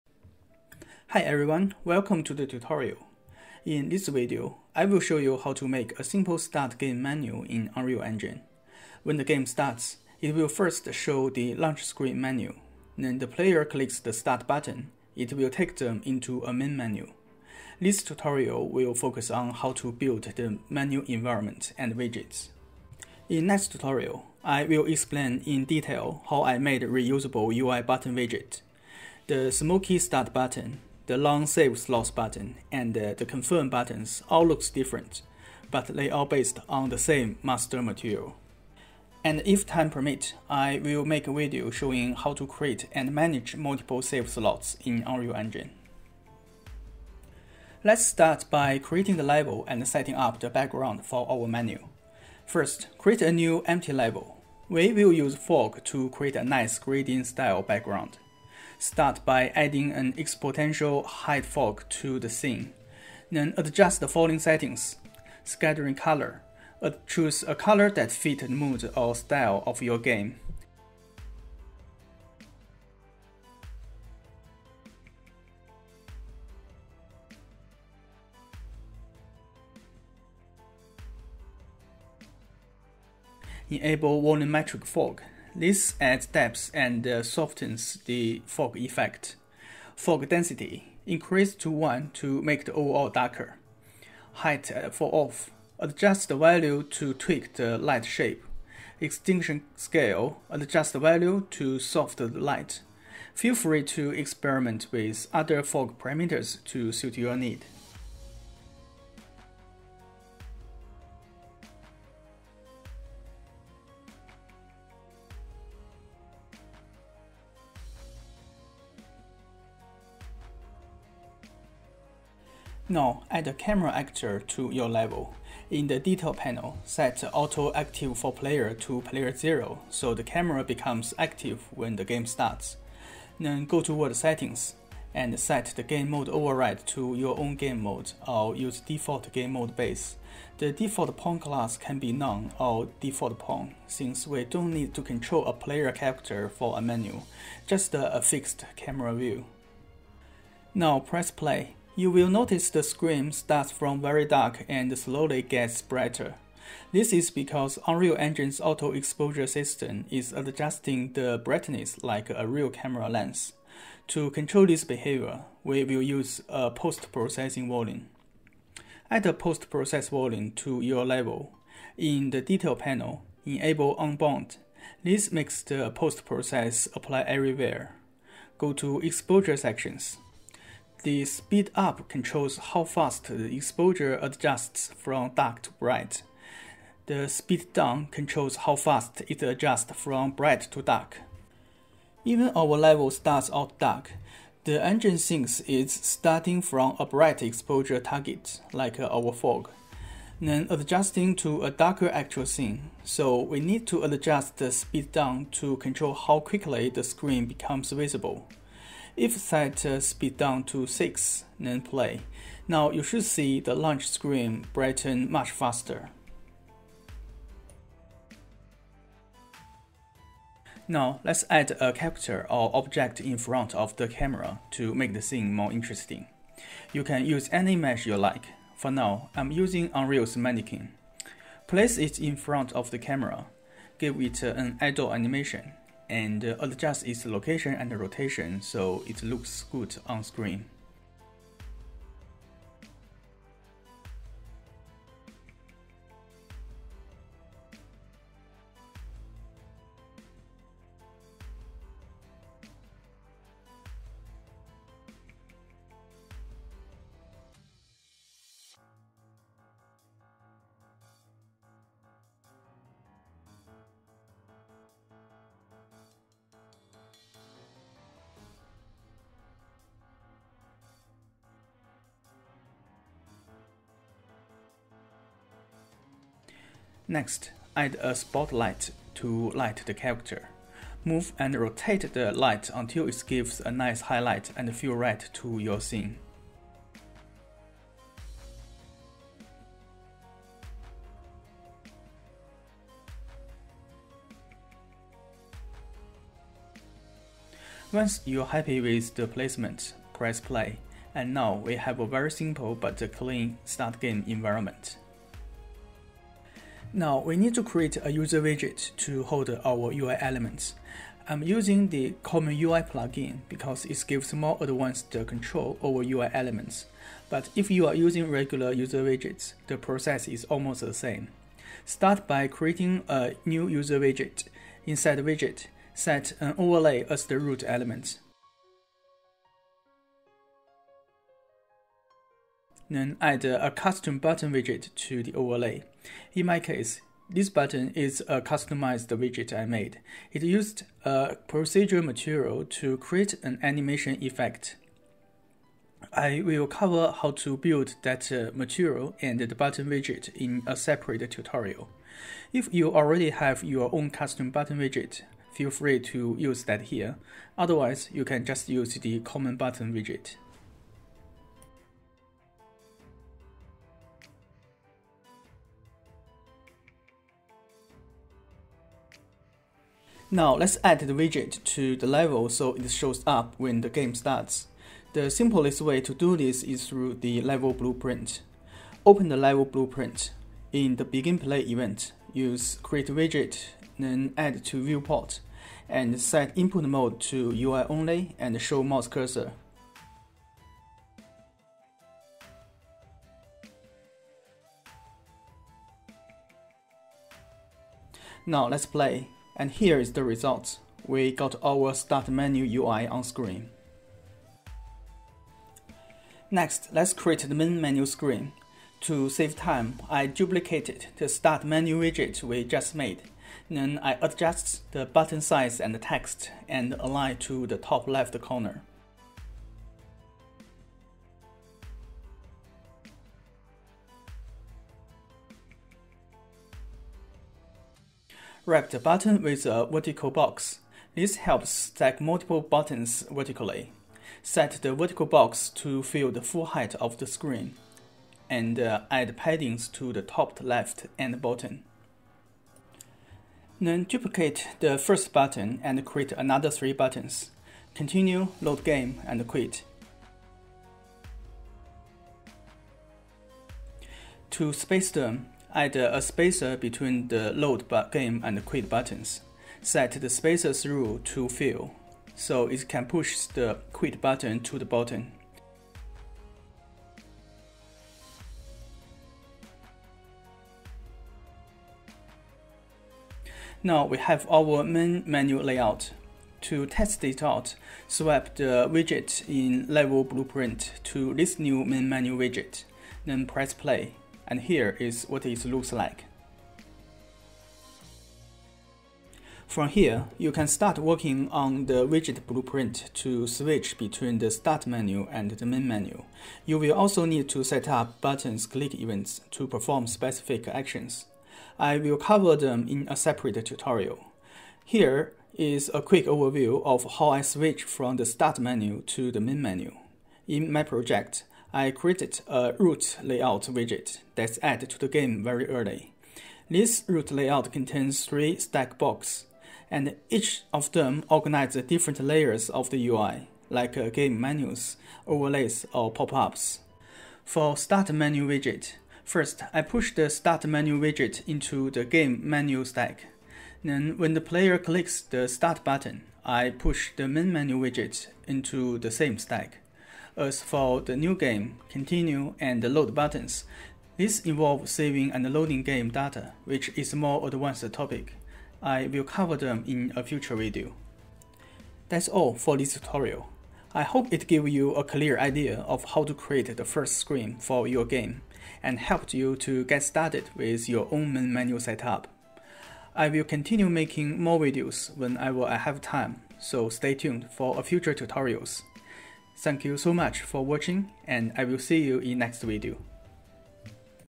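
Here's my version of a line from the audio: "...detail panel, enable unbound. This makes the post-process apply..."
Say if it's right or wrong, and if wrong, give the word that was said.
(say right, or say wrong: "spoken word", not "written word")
right.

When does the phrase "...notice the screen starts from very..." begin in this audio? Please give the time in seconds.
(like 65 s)
152 s.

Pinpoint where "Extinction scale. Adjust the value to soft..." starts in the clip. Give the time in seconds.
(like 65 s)
98 s.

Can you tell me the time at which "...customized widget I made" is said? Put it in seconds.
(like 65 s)
338 s.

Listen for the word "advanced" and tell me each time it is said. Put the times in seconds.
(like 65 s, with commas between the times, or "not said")
314 s, 547 s.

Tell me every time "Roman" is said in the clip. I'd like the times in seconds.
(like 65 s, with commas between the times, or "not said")
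not said.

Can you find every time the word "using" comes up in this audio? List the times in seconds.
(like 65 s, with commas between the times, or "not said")
229 s, 311 s, 317 s.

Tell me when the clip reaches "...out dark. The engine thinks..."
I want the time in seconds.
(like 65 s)
193 s.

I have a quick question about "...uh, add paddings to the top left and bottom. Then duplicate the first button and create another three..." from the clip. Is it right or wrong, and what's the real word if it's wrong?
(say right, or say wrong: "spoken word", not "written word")
right.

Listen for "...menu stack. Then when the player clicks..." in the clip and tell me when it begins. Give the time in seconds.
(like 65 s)
532 s.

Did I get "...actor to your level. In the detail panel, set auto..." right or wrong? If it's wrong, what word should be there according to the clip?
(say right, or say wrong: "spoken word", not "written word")
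right.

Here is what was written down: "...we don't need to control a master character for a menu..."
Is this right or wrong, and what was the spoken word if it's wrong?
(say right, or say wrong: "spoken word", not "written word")
wrong: "player", not "master".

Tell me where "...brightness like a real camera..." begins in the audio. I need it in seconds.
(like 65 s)
161 s.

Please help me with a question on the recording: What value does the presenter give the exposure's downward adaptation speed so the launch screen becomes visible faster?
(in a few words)
6.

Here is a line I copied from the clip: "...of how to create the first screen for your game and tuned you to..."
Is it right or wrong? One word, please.
wrong.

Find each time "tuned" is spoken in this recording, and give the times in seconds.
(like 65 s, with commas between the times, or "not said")
567 s.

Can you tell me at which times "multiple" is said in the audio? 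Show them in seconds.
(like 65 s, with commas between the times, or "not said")
43 s, 432 s.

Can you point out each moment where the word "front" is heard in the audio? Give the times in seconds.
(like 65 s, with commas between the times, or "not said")
223 s, 232 s.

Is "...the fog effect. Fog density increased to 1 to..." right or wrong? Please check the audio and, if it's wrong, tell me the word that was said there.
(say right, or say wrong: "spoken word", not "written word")
right.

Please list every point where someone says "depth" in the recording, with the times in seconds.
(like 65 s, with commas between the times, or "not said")
86 s.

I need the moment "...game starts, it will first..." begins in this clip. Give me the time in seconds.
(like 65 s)
9 s.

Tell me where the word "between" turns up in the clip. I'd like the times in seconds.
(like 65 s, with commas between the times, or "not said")
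456 s, 493 s.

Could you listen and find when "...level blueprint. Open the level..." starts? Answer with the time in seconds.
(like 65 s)
377 s.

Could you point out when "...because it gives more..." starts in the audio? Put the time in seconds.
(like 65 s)
313 s.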